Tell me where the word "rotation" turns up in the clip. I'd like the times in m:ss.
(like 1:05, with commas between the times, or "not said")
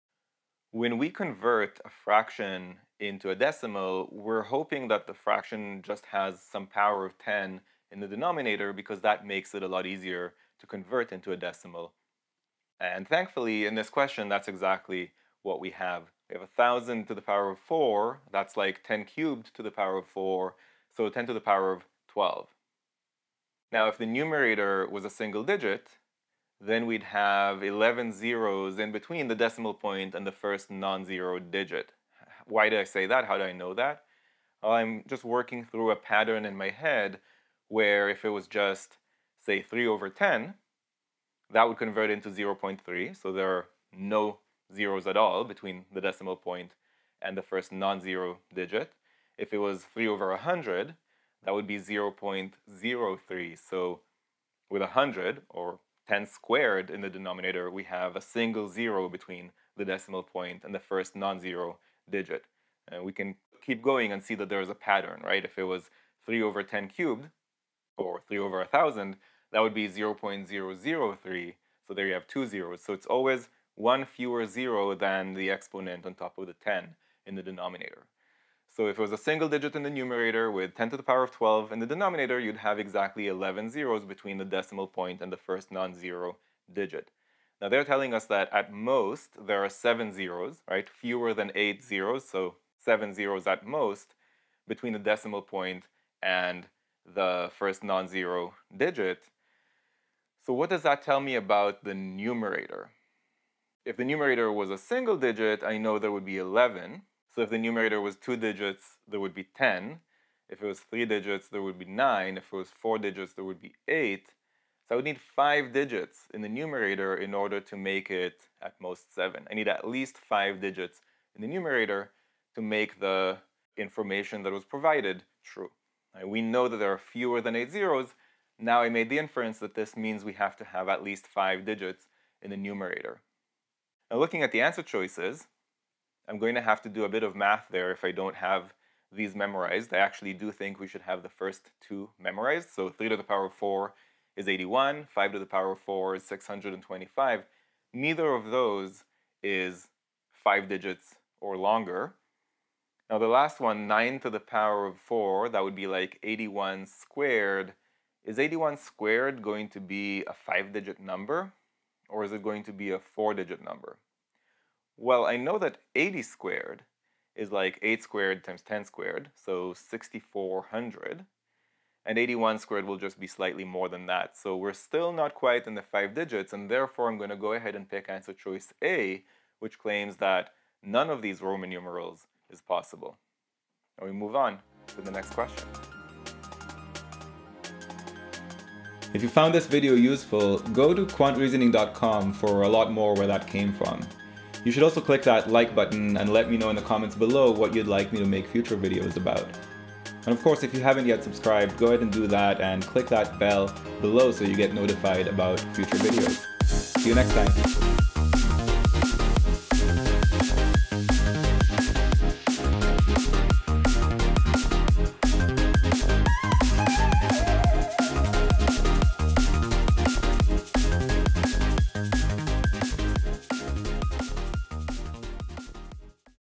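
not said.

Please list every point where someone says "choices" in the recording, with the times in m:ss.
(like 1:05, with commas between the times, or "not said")
2:14, 2:58.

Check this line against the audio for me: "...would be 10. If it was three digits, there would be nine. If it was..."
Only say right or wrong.
right.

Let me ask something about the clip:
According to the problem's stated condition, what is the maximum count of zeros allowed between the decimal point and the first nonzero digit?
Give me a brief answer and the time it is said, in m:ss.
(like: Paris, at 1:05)
7, at 1:32.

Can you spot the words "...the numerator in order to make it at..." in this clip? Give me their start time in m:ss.
1:56.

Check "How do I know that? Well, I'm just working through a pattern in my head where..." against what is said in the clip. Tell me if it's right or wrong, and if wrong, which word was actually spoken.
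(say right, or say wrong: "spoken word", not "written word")
right.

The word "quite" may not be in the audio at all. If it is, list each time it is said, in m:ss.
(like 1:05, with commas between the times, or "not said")
2:55.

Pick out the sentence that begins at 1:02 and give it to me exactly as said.
And we can keep going and see that there is a pattern, right?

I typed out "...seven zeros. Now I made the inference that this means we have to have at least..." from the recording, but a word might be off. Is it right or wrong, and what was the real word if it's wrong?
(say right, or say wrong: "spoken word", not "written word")
wrong: "eight", not "seven".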